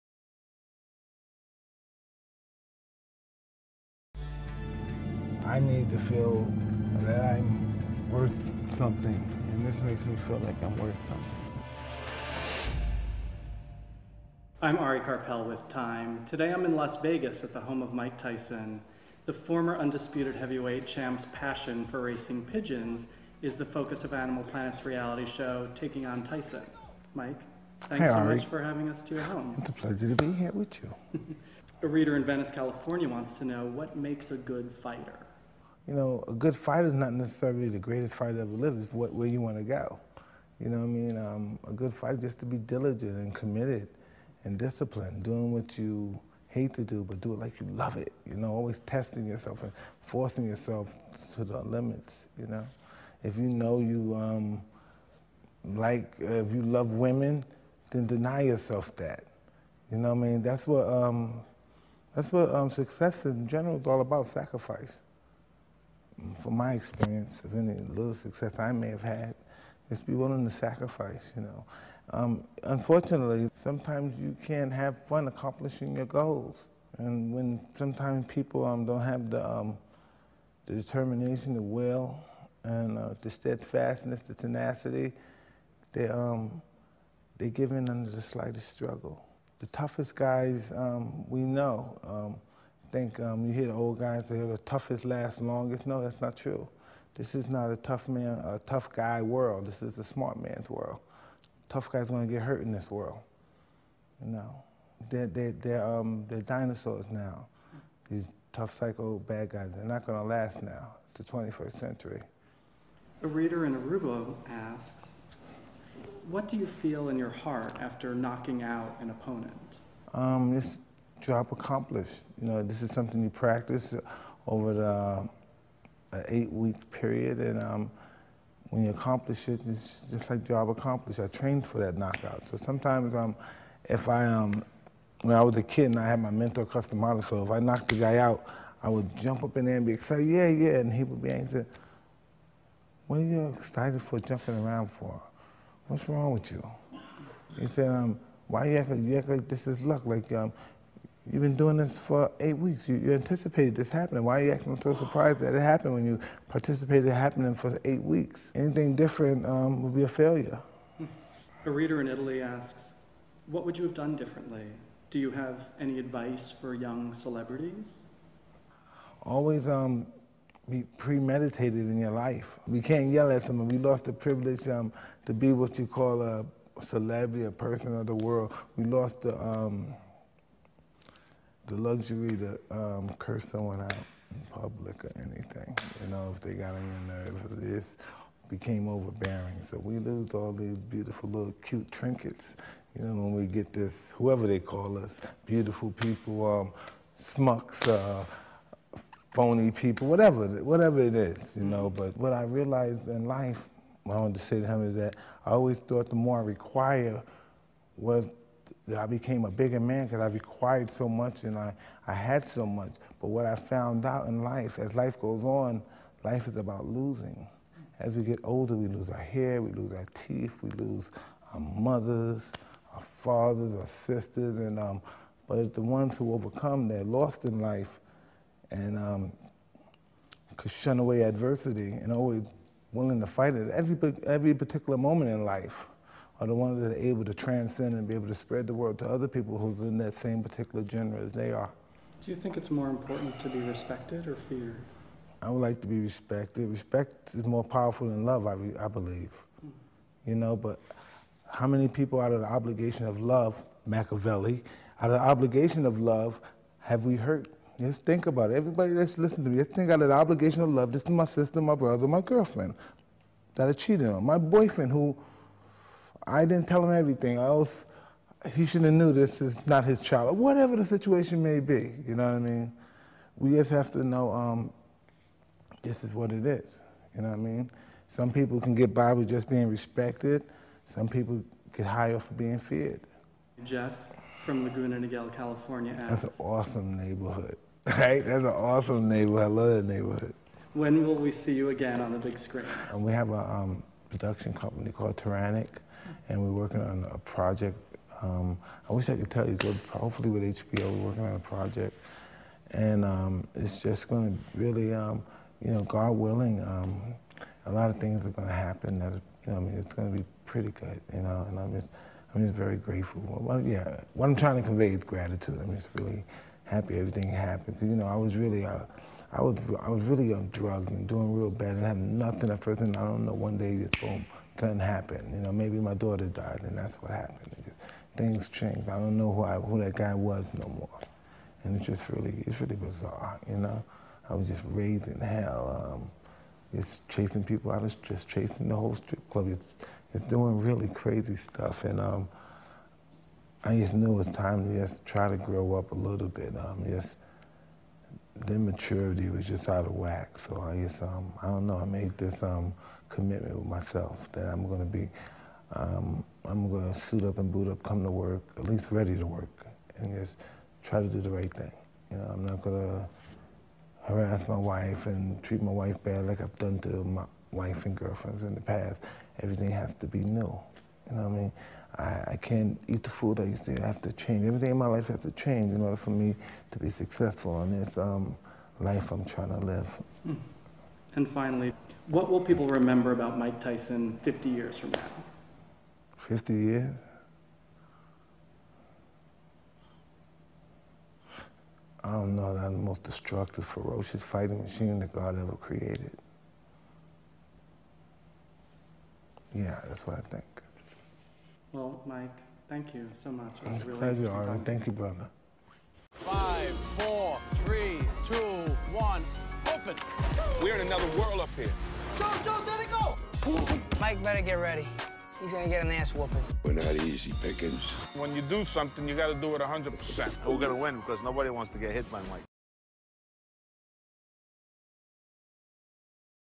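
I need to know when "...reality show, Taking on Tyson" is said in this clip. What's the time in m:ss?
0:24.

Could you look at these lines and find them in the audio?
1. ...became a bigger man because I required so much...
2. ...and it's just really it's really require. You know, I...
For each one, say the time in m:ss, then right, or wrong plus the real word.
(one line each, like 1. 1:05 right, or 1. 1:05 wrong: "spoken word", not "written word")
1. 3:29 right
2. 5:31 wrong: "bizarre", not "require".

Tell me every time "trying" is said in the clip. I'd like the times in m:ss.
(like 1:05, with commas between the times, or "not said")
5:14, 6:19.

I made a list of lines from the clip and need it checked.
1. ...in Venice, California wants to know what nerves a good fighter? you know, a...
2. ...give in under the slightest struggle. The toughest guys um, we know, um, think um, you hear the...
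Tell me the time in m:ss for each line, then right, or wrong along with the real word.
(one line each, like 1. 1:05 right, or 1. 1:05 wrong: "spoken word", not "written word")
1. 0:32 wrong: "makes", not "nerves"
2. 1:27 right.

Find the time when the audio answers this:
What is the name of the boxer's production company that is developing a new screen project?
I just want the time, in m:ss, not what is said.
4:55.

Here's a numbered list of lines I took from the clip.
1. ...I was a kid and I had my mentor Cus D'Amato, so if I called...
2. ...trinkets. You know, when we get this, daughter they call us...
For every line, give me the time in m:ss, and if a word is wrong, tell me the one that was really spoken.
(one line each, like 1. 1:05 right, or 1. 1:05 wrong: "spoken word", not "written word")
1. 2:15 wrong: "knocked", not "called"
2. 3:11 wrong: "whoever", not "daughter".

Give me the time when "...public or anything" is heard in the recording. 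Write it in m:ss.
3:04.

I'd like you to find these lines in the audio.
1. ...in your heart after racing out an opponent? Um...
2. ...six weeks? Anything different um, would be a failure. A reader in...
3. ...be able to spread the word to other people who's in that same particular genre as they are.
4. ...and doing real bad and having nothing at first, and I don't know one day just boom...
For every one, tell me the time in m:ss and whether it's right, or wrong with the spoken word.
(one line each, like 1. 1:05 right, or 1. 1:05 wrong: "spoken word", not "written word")
1. 1:57 wrong: "knocking", not "racing"
2. 2:37 wrong: "eight", not "six"
3. 3:58 right
4. 5:20 right.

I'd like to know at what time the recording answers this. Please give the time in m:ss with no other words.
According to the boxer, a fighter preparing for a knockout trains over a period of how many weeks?
2:06.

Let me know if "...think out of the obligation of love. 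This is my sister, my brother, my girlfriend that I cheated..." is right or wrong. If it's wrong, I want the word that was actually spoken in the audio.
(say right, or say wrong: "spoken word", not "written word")
right.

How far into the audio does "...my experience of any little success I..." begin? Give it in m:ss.
1:06.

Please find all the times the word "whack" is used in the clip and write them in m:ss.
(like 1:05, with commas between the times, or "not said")
5:49.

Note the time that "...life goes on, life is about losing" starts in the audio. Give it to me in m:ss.
3:34.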